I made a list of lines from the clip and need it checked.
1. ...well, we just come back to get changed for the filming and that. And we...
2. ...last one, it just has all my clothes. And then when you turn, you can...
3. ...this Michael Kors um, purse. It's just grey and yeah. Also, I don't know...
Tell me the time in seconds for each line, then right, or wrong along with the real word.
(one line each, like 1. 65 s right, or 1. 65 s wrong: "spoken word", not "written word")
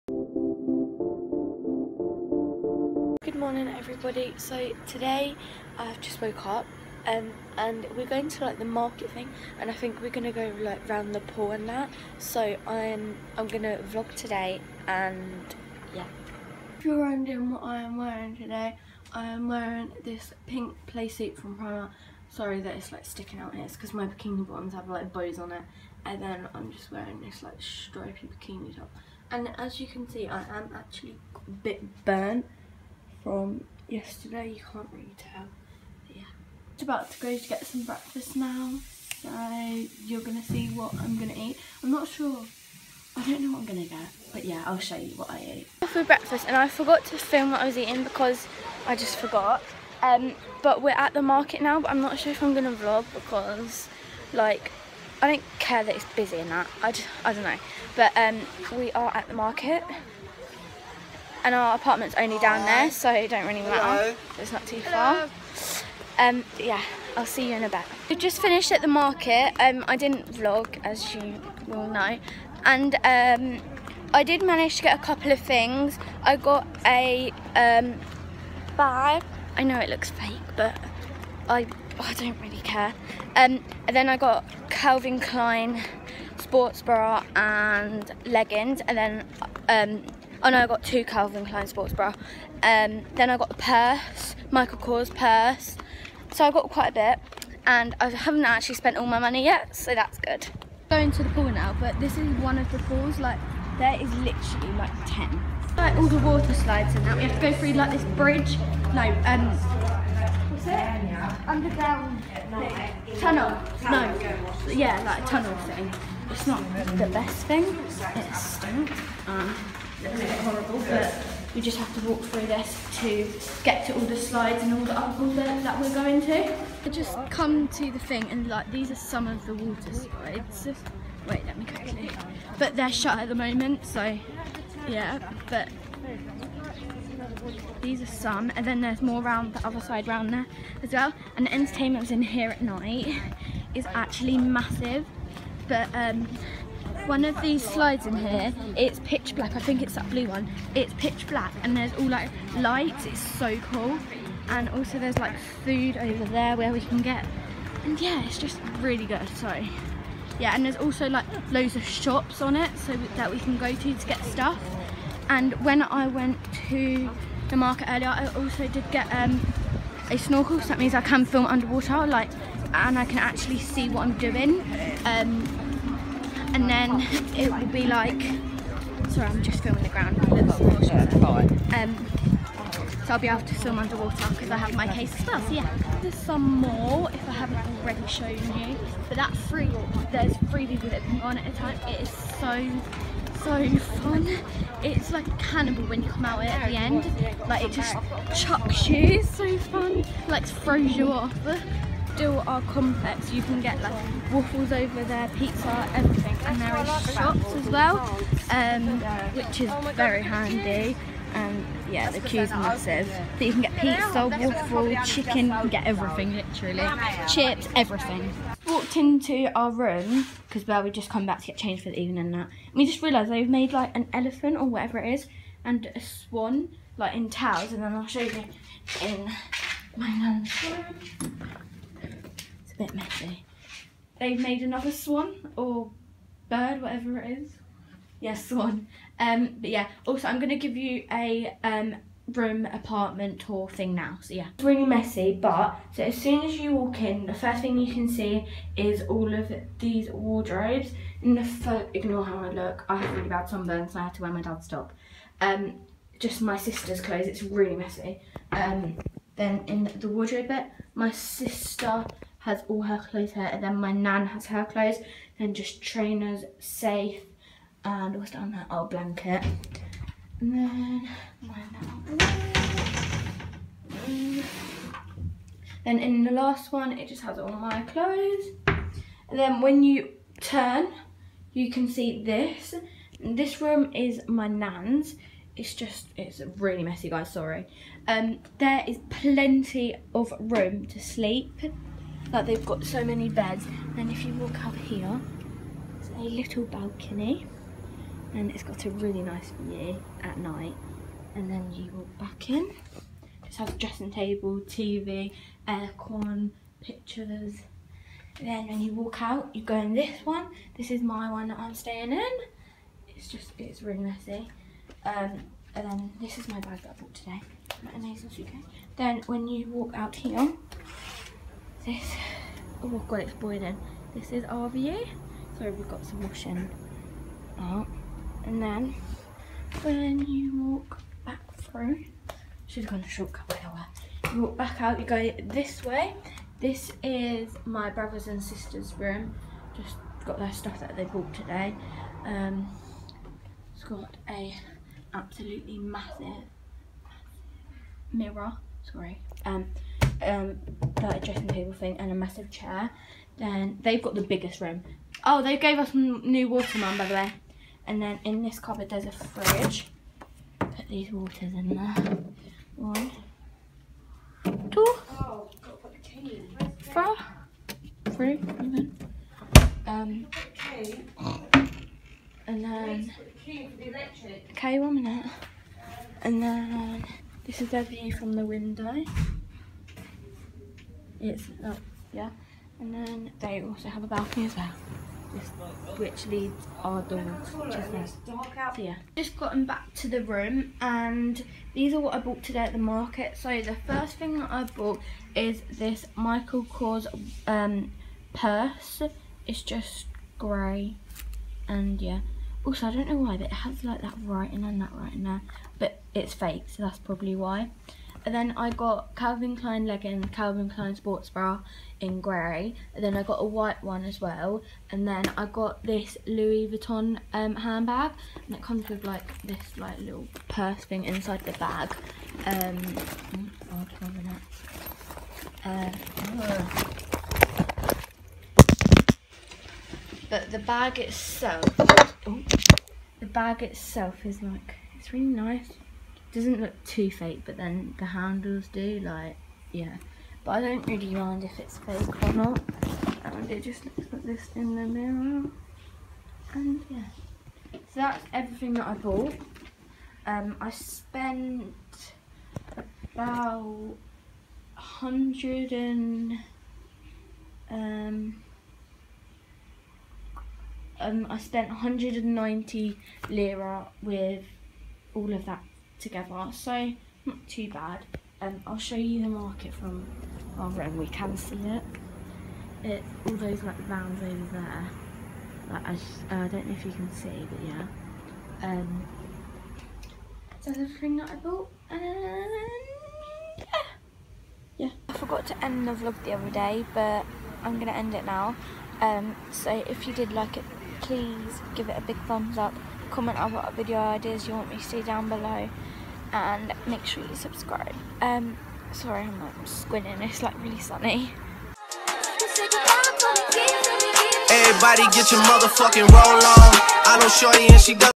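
1. 220 s wrong: "evening", not "filming"
2. 276 s right
3. 395 s right.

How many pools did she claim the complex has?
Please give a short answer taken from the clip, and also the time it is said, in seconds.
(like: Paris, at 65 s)
10, at 105 s.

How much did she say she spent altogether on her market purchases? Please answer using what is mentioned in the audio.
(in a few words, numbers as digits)
190 lira.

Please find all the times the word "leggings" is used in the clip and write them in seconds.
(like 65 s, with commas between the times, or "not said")
88 s, 409 s.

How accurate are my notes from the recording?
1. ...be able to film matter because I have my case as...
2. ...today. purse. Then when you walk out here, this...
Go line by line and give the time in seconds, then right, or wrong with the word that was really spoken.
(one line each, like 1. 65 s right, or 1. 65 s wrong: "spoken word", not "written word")
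1. 183 s wrong: "underwater", not "matter"
2. 317 s wrong: "suitcase", not "purse".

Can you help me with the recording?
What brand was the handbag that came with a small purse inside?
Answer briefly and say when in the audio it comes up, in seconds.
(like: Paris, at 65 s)
Louis Vuitton, at 416 s.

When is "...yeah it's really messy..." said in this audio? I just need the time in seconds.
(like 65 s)
244 s.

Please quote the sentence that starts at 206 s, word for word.
And there are shops as well, um, which is very handy.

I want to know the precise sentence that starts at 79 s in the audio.
I know it looks fake, but I I don't really care.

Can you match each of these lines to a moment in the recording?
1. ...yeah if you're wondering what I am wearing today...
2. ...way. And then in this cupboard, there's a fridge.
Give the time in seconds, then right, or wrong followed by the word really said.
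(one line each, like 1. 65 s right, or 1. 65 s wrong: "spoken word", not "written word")
1. 15 s right
2. 357 s right.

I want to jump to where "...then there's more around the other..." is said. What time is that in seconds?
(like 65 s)
138 s.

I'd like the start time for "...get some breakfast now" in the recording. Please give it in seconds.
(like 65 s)
37 s.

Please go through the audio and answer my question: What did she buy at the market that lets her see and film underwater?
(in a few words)
A snorkel.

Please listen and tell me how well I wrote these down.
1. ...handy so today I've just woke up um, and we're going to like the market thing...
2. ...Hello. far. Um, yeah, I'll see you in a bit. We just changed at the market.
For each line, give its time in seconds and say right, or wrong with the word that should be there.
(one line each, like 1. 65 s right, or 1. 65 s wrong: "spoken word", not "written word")
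1. 3 s wrong: "everybody", not "handy"
2. 64 s wrong: "finished", not "changed".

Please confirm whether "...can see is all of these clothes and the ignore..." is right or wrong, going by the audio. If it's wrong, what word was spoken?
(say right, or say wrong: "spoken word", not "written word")
wrong: "wardrobes", not "clothes".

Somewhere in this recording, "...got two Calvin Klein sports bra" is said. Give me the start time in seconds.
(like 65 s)
90 s.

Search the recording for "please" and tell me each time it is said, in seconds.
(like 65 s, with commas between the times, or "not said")
491 s.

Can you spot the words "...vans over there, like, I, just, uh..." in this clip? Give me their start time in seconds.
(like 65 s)
473 s.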